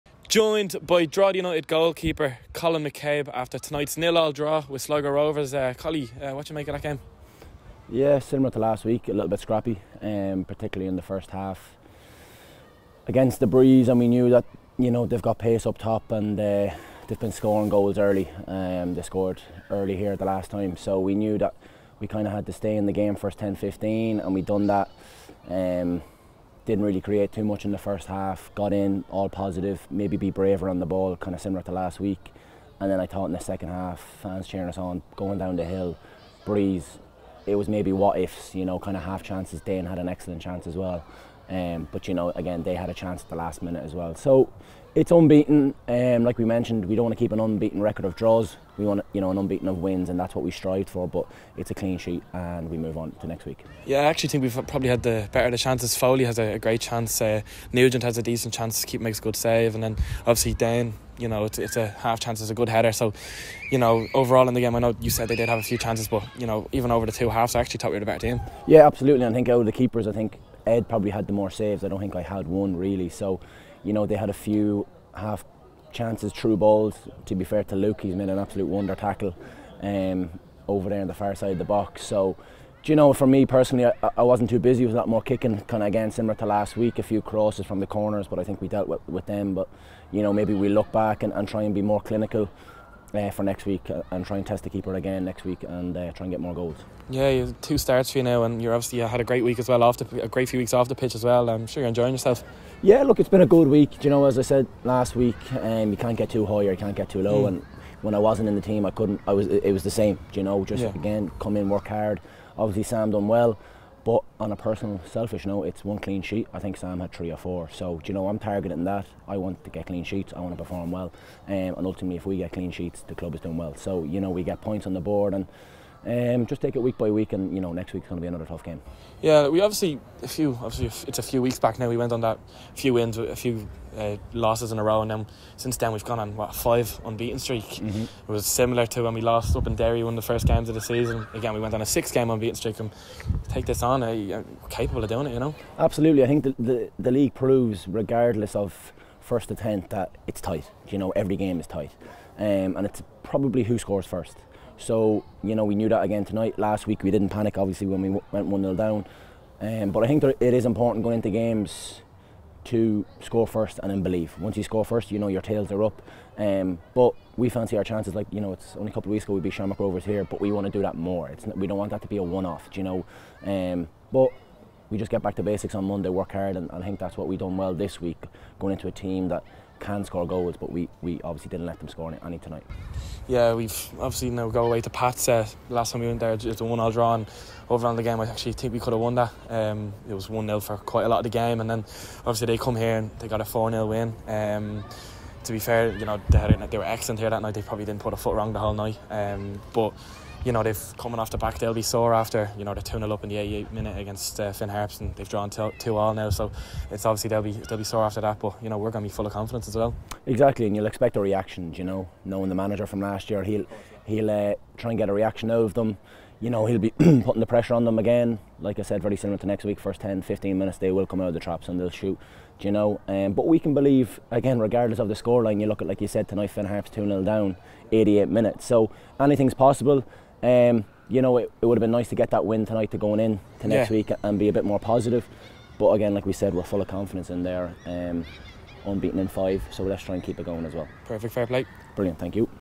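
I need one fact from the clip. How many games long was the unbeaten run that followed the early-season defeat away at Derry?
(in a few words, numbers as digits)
6.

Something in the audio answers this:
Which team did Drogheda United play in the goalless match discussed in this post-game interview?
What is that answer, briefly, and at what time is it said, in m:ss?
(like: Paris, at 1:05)
Sligo Rovers, at 0:04.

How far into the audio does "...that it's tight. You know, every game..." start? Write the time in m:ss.
2:29.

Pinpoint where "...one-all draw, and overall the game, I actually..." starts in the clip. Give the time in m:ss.
3:06.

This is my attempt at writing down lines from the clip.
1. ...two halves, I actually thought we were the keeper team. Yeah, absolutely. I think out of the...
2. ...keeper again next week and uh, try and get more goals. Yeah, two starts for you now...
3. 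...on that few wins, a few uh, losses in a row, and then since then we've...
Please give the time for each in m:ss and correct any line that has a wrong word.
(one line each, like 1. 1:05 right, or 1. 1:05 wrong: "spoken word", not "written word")
1. 1:07 wrong: "better", not "keeper"
2. 1:34 right
3. 2:12 right.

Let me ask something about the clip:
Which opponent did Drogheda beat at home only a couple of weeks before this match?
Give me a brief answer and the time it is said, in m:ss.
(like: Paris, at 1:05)
Shamrock Rovers, at 2:49.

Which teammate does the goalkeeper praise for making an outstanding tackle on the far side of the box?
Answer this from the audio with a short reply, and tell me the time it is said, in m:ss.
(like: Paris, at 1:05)
Luke, at 1:17.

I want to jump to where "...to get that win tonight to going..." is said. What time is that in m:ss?
3:52.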